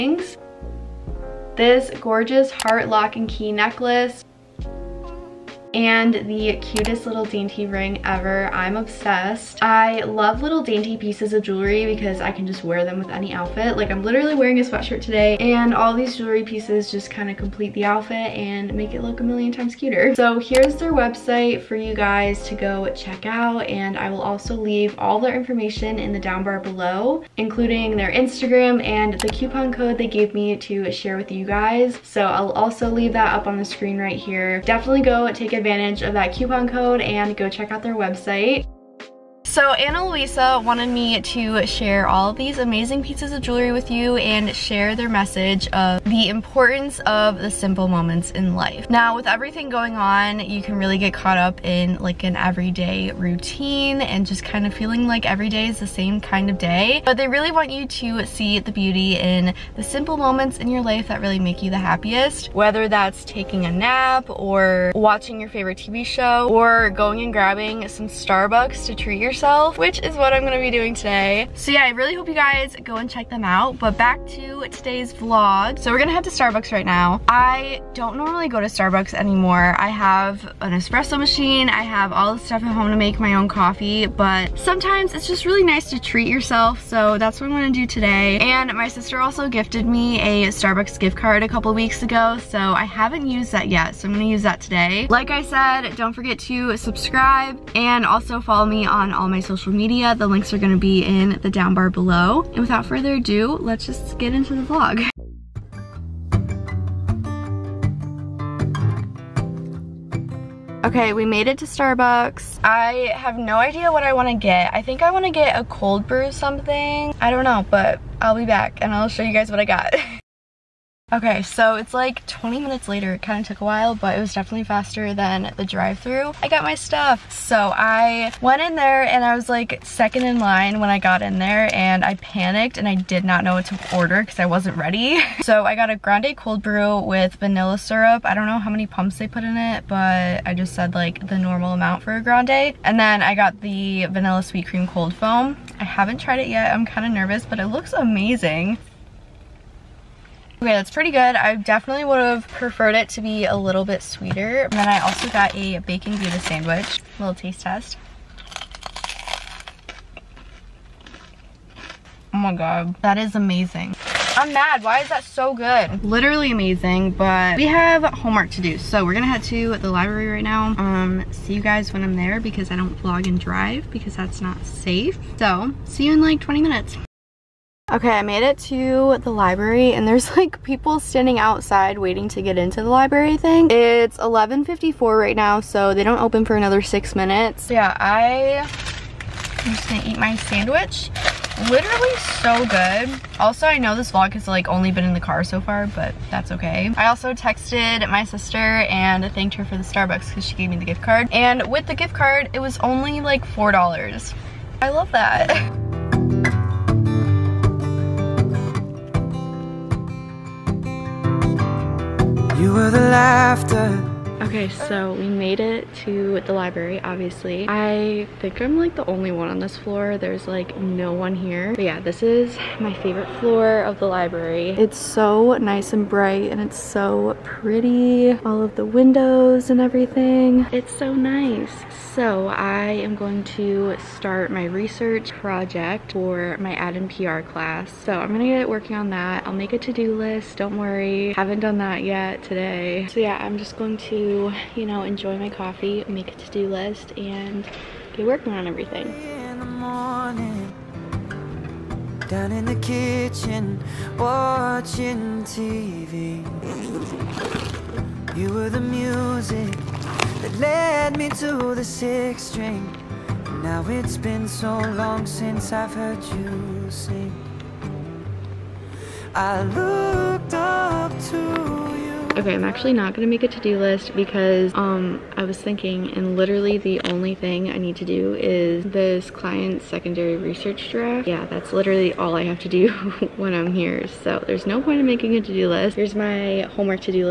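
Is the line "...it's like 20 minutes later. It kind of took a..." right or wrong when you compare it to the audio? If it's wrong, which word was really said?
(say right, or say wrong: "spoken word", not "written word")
right.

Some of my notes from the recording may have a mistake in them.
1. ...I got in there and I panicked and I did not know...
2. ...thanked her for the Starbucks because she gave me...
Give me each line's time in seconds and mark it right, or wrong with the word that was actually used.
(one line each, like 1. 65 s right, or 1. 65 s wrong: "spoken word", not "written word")
1. 130 s right
2. 199 s right.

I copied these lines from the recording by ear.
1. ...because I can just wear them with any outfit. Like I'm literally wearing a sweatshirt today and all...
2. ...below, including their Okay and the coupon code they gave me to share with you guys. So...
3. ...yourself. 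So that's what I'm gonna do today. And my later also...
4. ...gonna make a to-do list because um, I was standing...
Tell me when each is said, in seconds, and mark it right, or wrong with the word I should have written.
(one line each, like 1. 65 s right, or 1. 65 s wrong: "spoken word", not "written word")
1. 11 s right
2. 26 s wrong: "Instagram", not "Okay"
3. 86 s wrong: "sister", not "later"
4. 273 s wrong: "thinking", not "standing".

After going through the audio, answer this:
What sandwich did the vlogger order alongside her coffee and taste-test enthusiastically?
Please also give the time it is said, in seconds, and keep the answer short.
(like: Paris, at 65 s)
bacon gouda sandwich, at 155 s.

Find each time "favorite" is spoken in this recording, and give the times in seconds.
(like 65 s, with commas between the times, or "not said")
65 s, 222 s.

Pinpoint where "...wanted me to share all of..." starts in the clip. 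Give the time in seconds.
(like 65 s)
40 s.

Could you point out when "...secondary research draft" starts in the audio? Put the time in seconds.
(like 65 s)
279 s.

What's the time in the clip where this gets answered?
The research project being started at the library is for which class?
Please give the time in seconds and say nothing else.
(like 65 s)
236 s.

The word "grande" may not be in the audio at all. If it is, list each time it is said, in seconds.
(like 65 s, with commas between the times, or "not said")
135 s, 142 s.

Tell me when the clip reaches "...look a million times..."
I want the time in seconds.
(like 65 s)
19 s.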